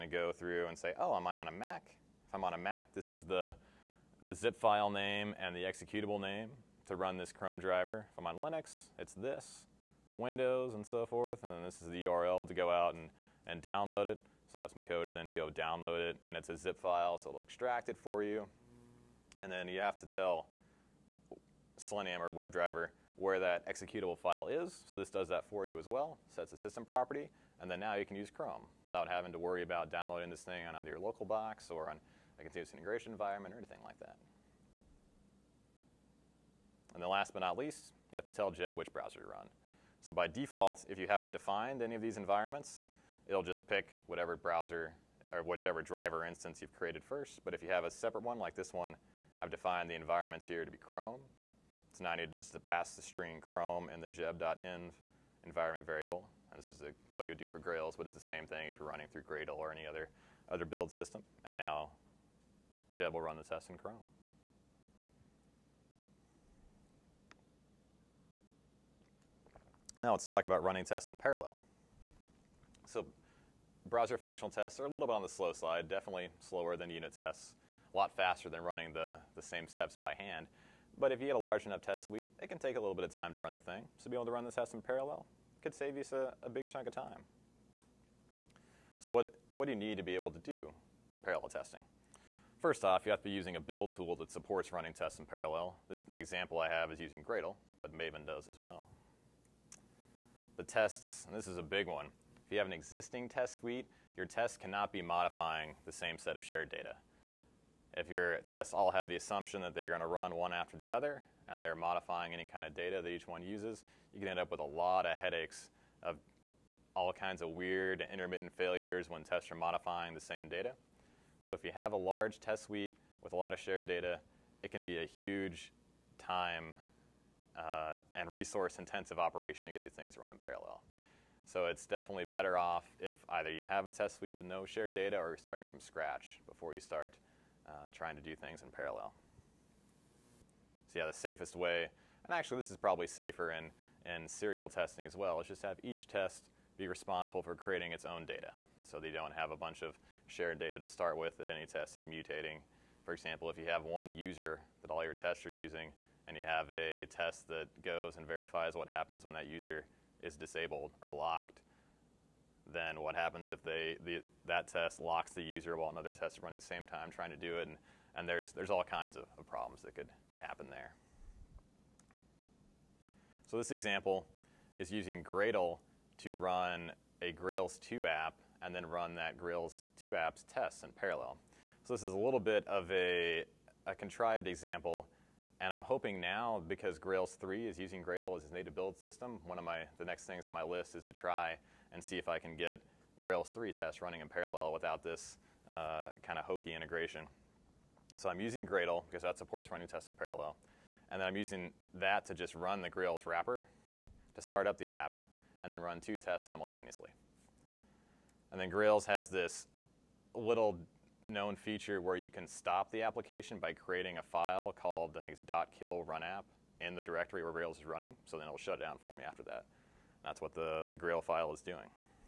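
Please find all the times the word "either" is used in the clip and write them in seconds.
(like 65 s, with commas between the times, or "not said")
30 s, 133 s.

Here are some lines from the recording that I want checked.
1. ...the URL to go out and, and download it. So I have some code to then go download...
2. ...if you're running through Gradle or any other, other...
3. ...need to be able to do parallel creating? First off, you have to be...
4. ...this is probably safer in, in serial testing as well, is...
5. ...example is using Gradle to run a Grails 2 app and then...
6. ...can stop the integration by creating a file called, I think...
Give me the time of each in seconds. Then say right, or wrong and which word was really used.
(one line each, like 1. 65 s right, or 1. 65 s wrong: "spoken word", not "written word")
1. 11 s right
2. 58 s right
3. 89 s wrong: "testing", not "creating"
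4. 142 s right
5. 173 s right
6. 212 s wrong: "application", not "integration".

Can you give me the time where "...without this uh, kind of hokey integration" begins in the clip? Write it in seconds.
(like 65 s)
194 s.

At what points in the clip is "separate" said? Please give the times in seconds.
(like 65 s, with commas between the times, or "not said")
47 s.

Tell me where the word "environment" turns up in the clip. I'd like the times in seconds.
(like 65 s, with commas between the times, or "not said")
33 s, 42 s, 49 s, 55 s.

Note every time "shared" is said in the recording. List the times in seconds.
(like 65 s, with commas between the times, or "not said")
106 s, 123 s, 134 s, 150 s.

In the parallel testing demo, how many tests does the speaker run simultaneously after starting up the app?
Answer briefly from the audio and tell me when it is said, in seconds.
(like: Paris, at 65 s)
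2, at 205 s.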